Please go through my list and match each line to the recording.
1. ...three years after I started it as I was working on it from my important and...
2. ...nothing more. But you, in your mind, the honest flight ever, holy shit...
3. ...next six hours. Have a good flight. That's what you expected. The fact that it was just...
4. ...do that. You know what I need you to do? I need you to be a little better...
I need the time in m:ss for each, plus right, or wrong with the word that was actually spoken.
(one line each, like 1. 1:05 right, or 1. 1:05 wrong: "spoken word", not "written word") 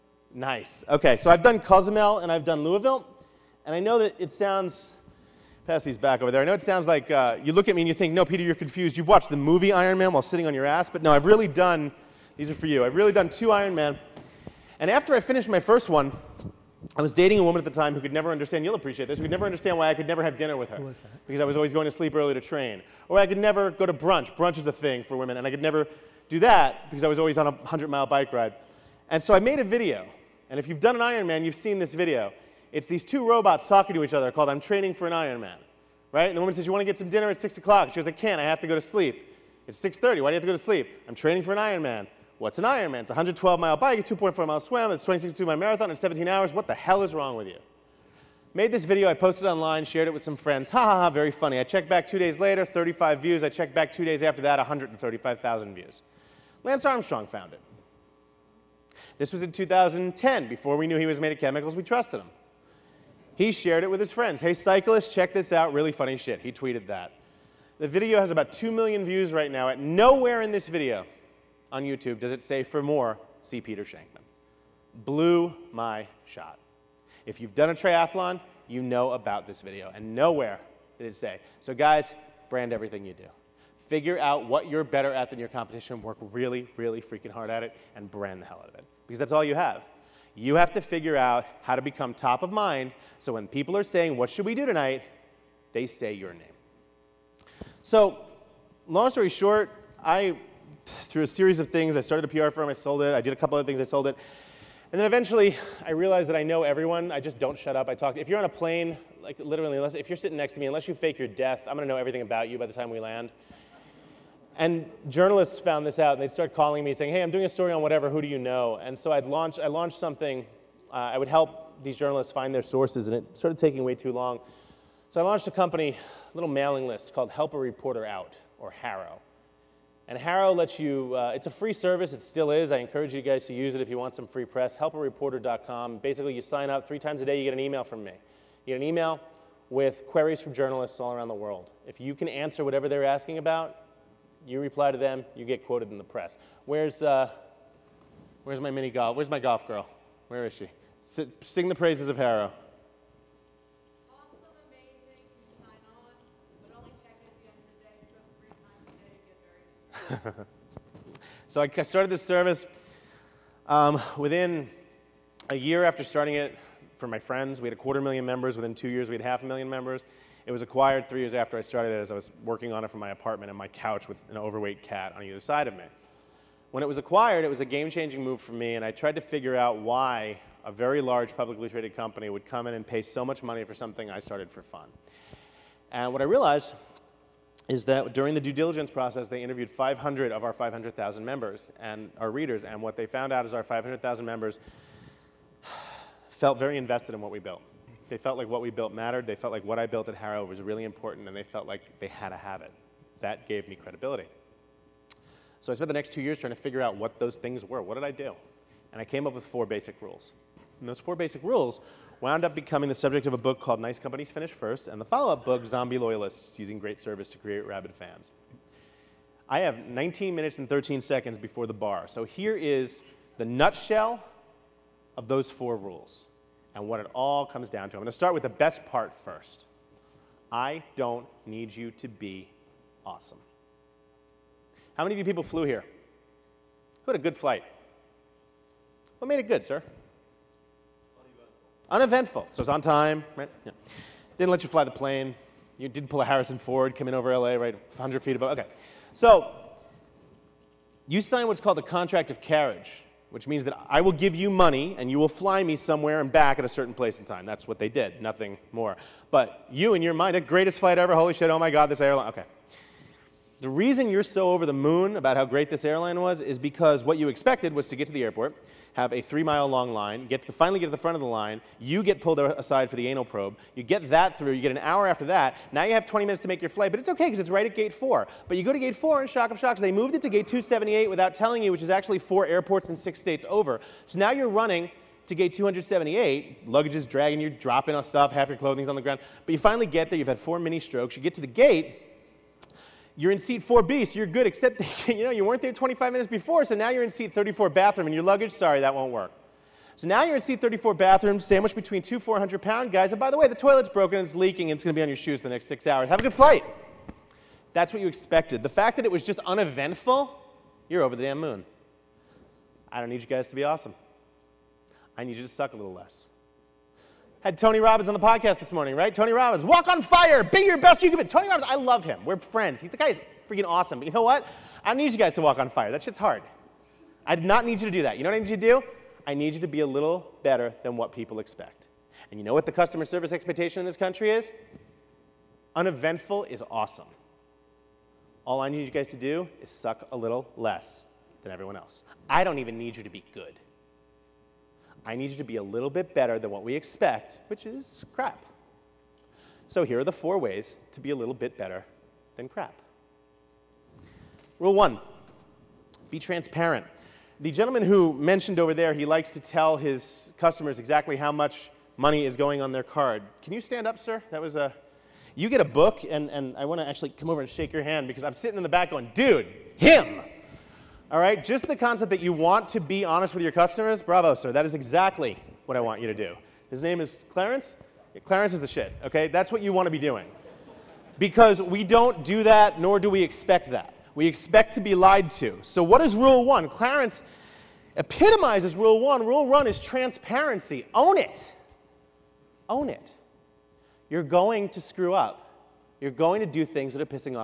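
1. 2:51 wrong: "apartment", not "important"
2. 4:18 wrong: "greatest", not "honest"
3. 5:05 right
4. 5:27 right.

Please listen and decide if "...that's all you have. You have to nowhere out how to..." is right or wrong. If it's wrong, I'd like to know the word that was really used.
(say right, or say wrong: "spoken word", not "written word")
wrong: "figure", not "nowhere".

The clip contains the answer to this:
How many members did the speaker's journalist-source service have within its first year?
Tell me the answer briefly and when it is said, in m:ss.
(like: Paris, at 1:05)
a quarter million, at 2:47.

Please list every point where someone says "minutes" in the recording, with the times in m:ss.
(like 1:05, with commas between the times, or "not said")
3:40, 4:36, 4:56.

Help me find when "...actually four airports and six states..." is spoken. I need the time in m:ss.
4:41.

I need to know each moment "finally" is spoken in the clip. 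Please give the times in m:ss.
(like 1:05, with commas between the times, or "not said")
4:30, 4:49.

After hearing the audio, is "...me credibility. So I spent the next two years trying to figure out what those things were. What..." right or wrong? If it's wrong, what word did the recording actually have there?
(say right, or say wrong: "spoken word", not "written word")
right.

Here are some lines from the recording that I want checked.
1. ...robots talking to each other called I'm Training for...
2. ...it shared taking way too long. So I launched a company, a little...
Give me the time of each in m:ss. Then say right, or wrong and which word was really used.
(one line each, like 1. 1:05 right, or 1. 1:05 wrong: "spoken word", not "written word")
1. 0:33 right
2. 2:03 wrong: "started", not "shared".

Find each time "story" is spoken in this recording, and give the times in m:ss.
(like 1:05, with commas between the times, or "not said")
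1:39, 1:57.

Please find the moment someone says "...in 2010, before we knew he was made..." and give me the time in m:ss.
0:59.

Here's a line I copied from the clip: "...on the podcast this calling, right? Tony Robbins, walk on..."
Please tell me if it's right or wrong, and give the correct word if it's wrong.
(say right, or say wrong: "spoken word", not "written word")
wrong: "morning", not "calling".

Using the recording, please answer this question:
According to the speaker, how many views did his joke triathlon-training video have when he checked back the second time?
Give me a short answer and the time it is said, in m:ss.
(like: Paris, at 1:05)
135,000, at 0:54.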